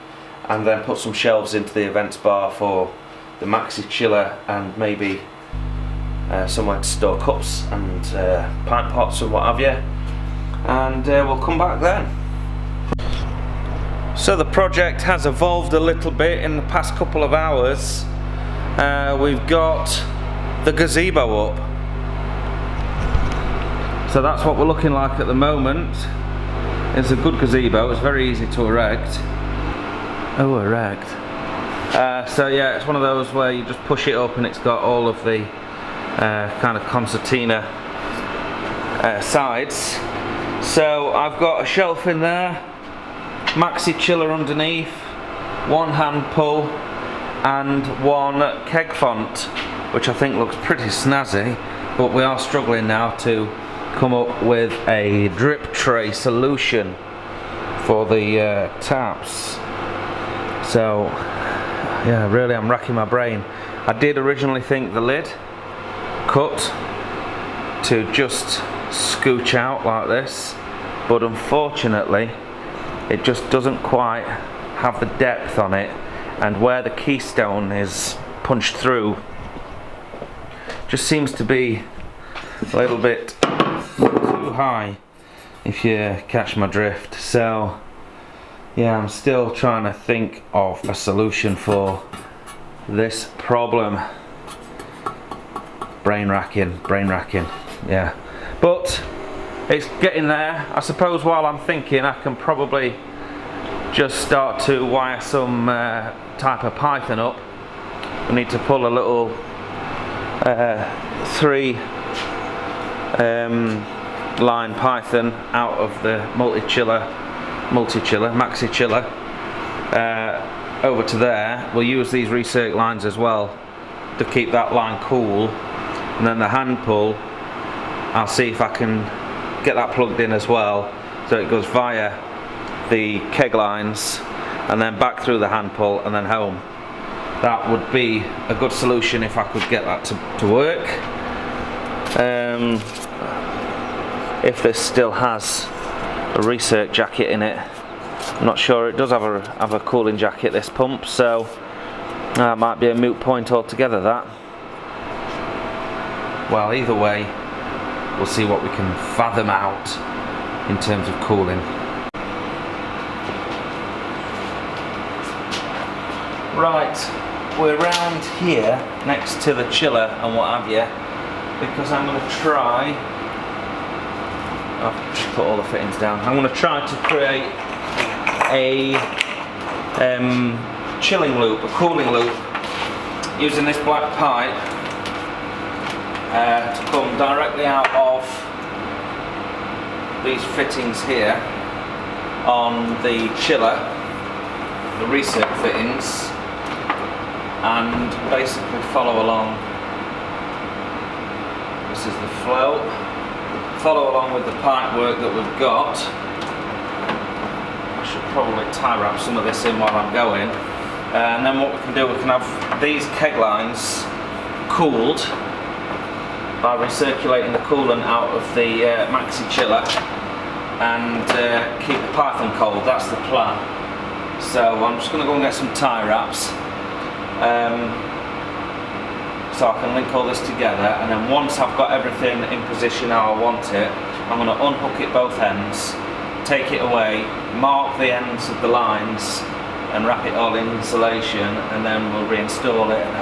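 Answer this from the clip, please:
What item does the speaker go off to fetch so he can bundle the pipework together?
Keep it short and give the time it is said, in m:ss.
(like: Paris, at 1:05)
Tie wraps, at 3:45.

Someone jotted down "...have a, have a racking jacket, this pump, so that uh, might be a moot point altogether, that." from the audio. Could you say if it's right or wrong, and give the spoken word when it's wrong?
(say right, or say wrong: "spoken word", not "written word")
wrong: "cooling", not "racking".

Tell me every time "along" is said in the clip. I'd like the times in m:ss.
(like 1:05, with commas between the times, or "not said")
3:19, 3:24.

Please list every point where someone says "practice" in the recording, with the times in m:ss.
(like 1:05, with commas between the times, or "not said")
not said.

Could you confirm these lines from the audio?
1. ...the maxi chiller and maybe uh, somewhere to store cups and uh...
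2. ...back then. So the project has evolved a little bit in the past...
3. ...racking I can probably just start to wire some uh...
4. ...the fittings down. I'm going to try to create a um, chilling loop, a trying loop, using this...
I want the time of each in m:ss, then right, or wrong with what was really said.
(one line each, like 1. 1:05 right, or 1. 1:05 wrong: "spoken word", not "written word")
1. 0:03 right
2. 0:11 right
3. 1:41 wrong: "thinking", not "racking"
4. 2:55 wrong: "cooling", not "trying".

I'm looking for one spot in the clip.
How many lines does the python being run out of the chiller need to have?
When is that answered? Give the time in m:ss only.
1:51.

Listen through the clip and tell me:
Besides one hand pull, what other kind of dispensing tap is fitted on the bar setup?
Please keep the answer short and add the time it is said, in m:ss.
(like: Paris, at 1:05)
Keg font, at 0:48.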